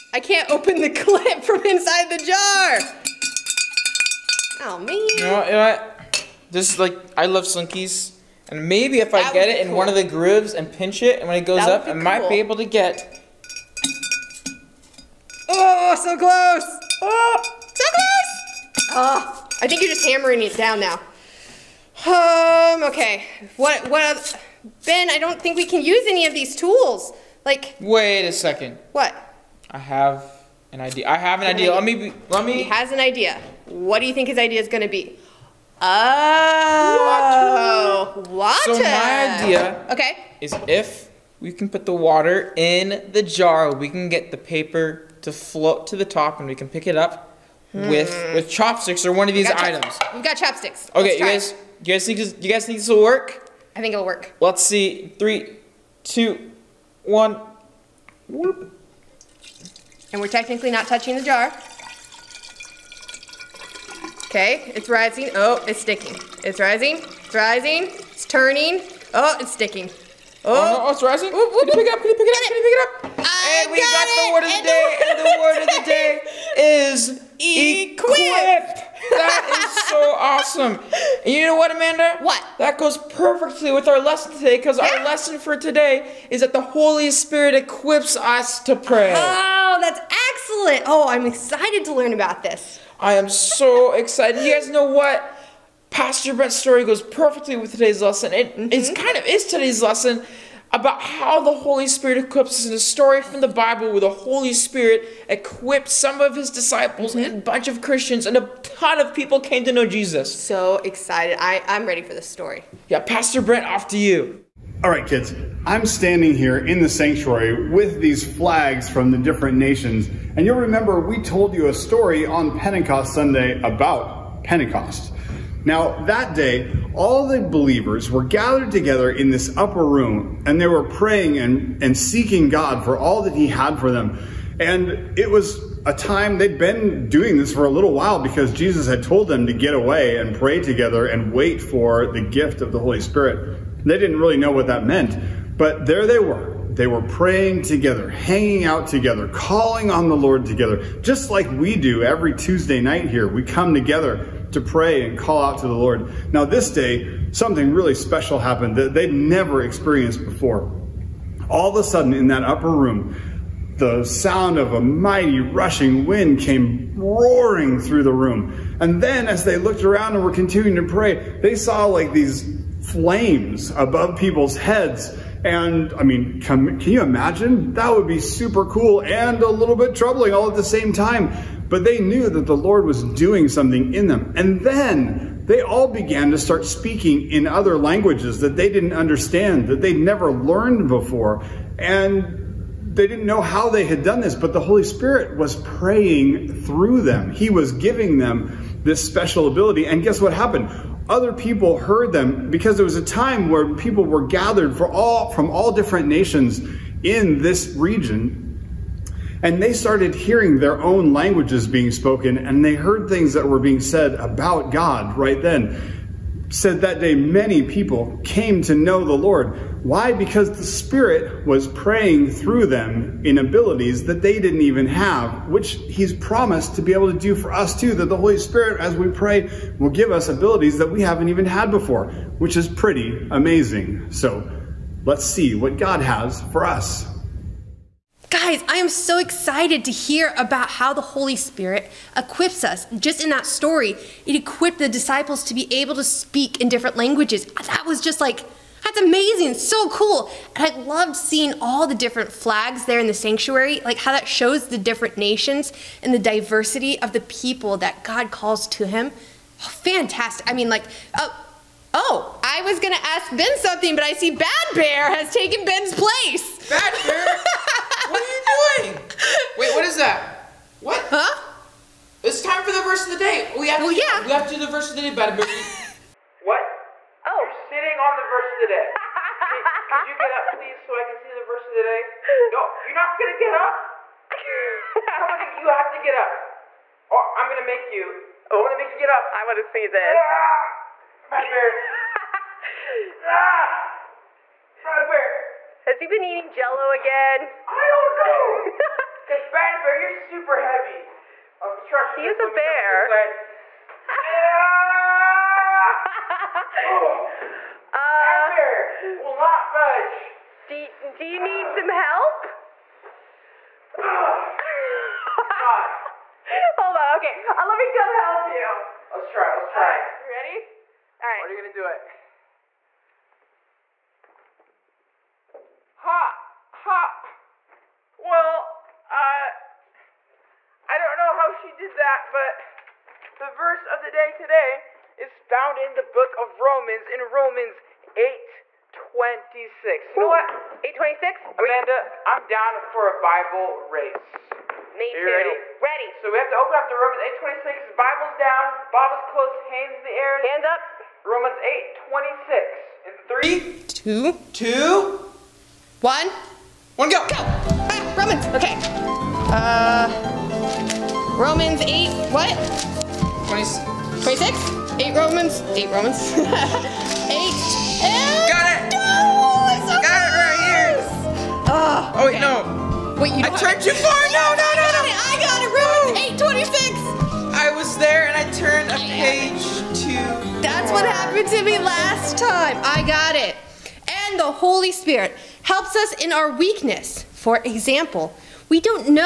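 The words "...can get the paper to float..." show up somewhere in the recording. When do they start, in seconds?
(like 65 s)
43 s.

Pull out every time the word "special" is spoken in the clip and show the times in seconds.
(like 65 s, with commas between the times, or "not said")
157 s, 199 s.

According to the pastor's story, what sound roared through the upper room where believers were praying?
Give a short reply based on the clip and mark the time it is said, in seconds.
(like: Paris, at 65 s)
Mighty rushing wind, at 164 s.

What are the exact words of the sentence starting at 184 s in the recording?
And then they all began to start speaking in other languages that they didn't understand, that they'd never learned before.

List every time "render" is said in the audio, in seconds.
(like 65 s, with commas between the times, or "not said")
not said.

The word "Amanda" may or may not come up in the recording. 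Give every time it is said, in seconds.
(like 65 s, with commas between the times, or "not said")
81 s, 341 s.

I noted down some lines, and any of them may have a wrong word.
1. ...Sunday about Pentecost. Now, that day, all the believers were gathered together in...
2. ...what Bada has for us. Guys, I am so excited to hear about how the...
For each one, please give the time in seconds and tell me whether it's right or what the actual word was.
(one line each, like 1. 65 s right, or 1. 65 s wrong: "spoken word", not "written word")
1. 123 s right
2. 235 s wrong: "God", not "Bada".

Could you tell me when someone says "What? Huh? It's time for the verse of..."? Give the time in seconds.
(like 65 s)
270 s.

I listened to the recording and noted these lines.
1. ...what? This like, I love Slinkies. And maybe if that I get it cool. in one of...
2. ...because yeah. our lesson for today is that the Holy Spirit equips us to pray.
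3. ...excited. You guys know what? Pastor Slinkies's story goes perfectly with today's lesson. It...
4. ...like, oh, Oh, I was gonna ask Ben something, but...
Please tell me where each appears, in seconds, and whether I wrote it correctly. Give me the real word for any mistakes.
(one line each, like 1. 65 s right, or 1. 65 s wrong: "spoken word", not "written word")
1. 5 s right
2. 84 s right
3. 93 s wrong: "Brent", not "Slinkies"
4. 260 s right.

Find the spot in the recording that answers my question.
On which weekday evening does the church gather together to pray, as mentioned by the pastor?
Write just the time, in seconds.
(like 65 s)
152 s.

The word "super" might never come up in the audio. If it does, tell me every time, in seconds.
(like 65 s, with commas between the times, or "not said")
178 s, 300 s.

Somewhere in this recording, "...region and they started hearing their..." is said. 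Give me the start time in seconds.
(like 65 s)
207 s.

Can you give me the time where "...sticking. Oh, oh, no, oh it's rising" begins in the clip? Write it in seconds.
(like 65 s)
69 s.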